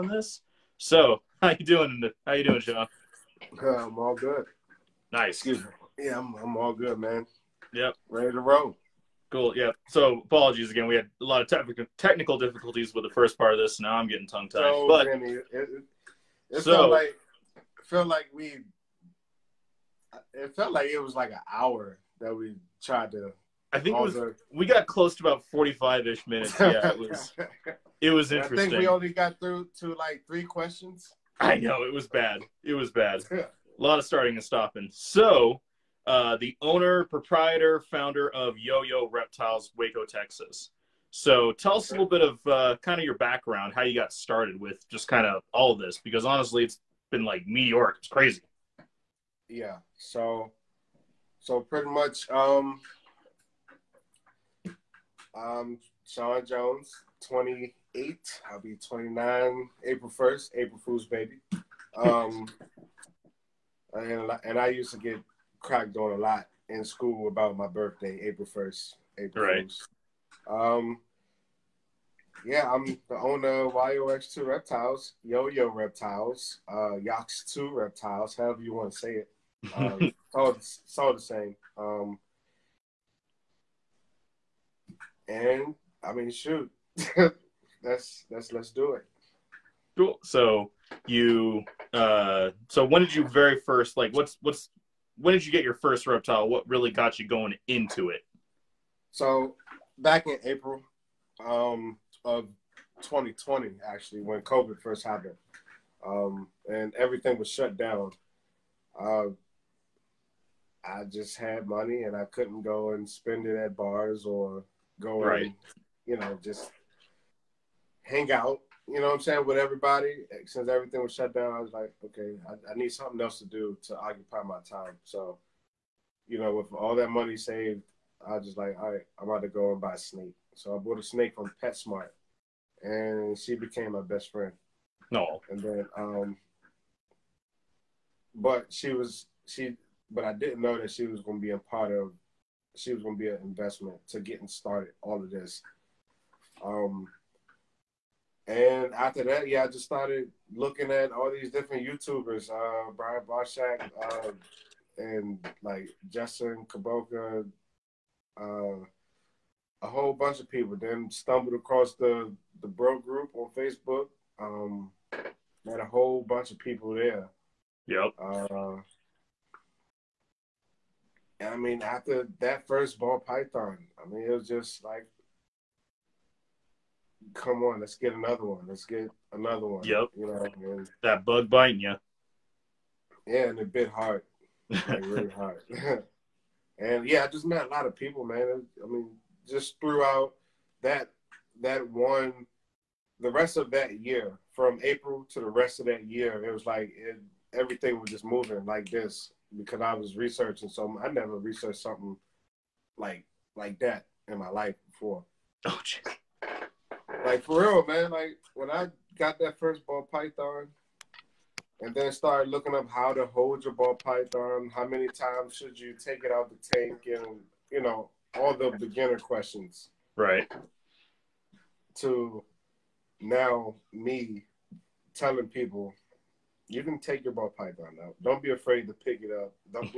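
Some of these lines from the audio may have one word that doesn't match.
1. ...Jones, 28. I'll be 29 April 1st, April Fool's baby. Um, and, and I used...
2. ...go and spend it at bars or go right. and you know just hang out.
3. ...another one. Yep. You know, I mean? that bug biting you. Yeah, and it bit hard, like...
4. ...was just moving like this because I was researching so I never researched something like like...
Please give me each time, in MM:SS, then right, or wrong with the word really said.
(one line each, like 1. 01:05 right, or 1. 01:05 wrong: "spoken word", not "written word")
1. 00:56 right
2. 01:52 right
3. 02:59 right
4. 03:17 right.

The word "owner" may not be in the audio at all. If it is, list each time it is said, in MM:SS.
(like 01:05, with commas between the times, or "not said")
00:36, 01:13.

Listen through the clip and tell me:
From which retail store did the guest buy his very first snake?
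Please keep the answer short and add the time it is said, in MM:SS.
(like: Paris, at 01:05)
PetSmart, at 02:11.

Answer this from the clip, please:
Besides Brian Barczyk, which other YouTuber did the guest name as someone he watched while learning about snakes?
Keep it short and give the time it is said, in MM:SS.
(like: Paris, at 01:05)
Justin Kobylka, at 02:36.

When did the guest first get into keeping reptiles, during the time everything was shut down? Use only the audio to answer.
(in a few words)
April 2020.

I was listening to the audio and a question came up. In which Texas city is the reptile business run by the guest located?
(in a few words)
Waco.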